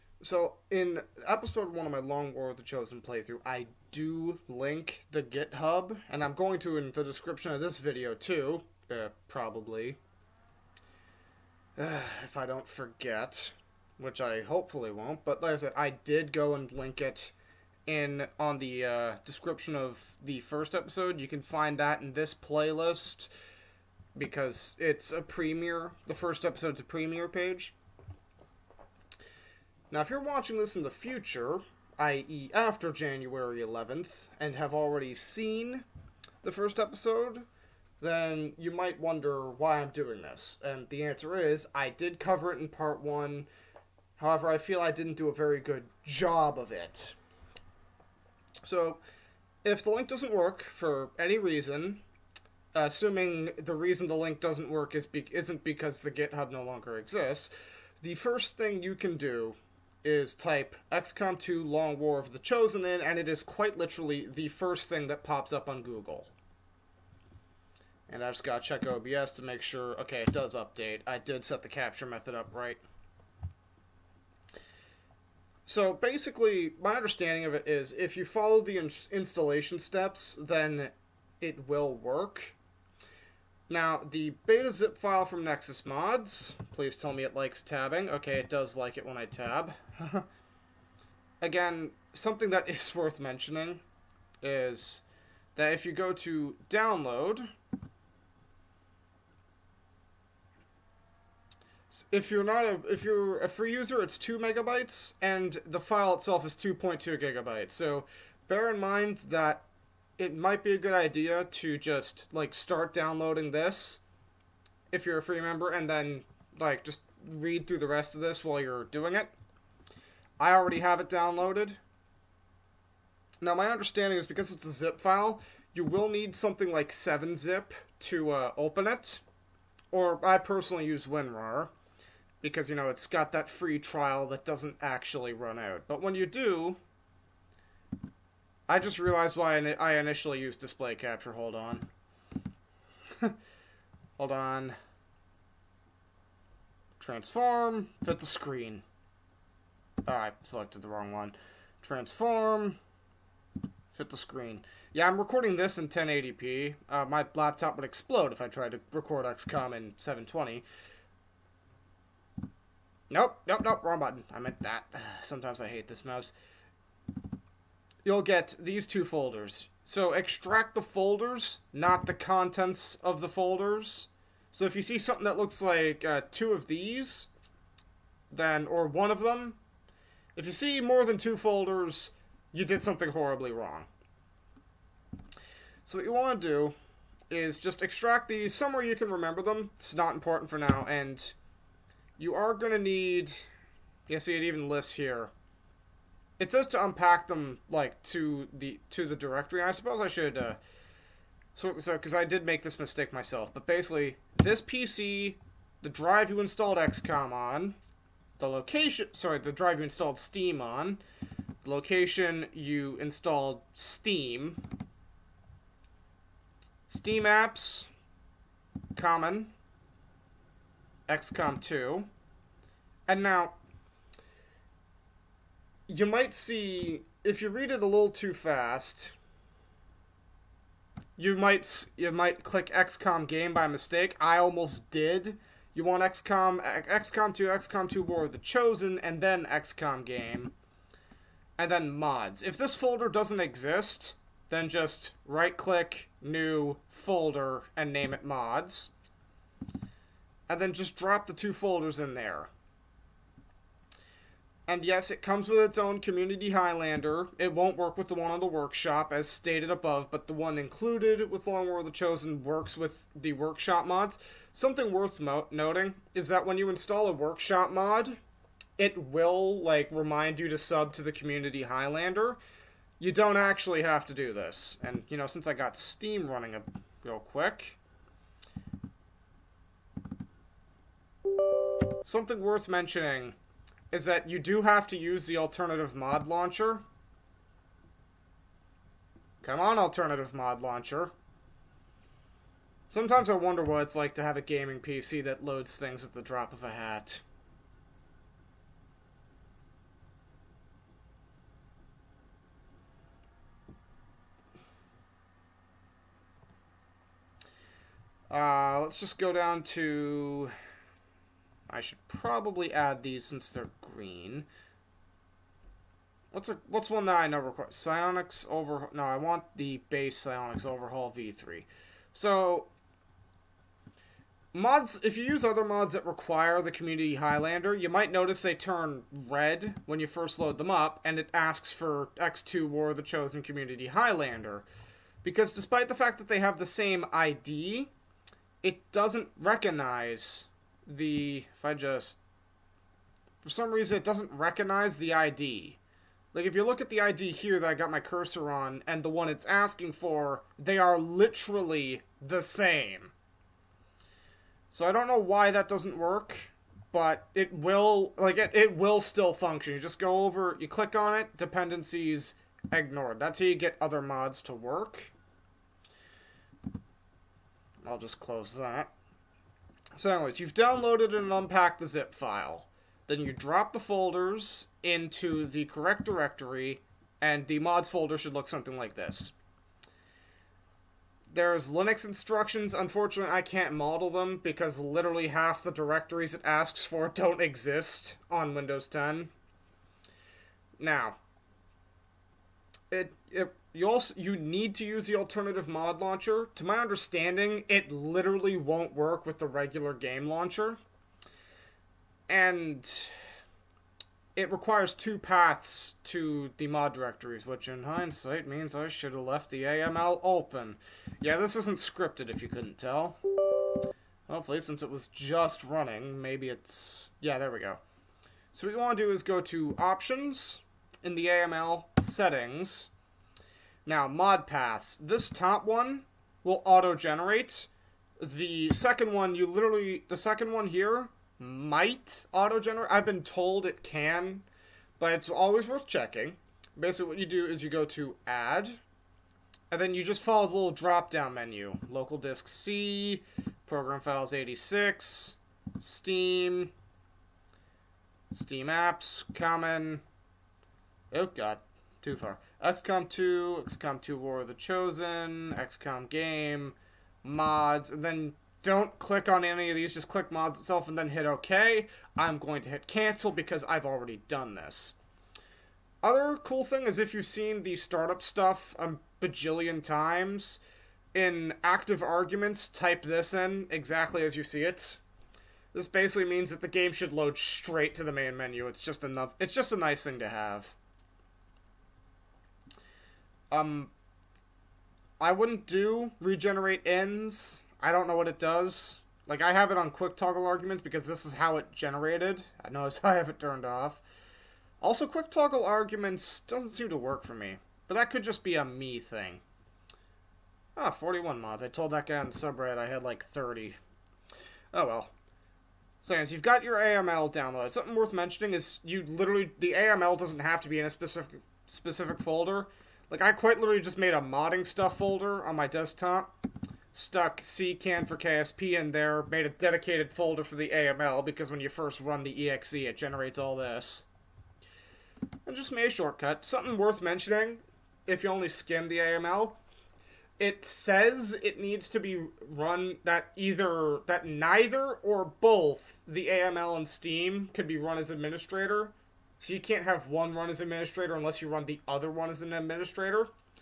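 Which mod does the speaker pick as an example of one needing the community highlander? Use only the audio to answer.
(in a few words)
Psionics Overhaul V3.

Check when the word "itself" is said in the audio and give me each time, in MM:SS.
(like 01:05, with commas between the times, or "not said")
01:46, 07:40.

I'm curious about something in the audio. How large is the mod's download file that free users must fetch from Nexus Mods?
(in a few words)
2.2 gigabytes.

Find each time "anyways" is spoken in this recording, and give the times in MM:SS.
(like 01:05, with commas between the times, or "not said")
06:10, 08:26.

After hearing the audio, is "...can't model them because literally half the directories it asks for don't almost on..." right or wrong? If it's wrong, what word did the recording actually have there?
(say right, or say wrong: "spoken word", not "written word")
wrong: "exist", not "almost".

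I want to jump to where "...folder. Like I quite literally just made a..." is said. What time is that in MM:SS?
08:32.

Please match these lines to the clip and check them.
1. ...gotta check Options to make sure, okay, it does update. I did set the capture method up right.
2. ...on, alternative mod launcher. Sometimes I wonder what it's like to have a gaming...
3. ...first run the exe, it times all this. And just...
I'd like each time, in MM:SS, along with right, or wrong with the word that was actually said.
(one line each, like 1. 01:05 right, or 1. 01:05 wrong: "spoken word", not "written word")
1. 01:08 wrong: "OBS", not "Options"
2. 04:49 right
3. 08:41 wrong: "generates", not "times".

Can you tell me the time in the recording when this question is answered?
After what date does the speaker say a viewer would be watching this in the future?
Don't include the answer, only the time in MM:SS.
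00:32.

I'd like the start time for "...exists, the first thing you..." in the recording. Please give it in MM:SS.
00:56.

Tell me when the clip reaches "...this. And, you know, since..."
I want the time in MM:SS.
04:34.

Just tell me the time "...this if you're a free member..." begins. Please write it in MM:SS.
01:53.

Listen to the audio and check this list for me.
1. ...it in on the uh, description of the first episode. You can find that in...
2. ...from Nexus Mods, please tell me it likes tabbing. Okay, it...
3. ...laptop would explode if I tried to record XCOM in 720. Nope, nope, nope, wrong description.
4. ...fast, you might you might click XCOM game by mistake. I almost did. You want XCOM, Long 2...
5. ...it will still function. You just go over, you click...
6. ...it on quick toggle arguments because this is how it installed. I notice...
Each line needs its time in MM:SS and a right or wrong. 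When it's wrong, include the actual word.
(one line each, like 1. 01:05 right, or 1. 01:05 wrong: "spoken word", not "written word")
1. 00:17 right
2. 01:25 right
3. 02:37 wrong: "button", not "description"
4. 03:48 wrong: "XCOM", not "Long"
5. 05:58 right
6. 08:09 wrong: "generated", not "installed".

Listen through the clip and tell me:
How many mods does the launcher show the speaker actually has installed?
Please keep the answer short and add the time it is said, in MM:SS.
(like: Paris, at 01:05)
41, at 08:20.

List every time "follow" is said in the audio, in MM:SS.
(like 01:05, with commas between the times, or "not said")
01:18, 07:20.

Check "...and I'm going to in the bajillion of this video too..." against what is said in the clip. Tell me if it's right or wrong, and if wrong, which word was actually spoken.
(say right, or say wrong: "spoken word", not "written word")
wrong: "description", not "bajillion".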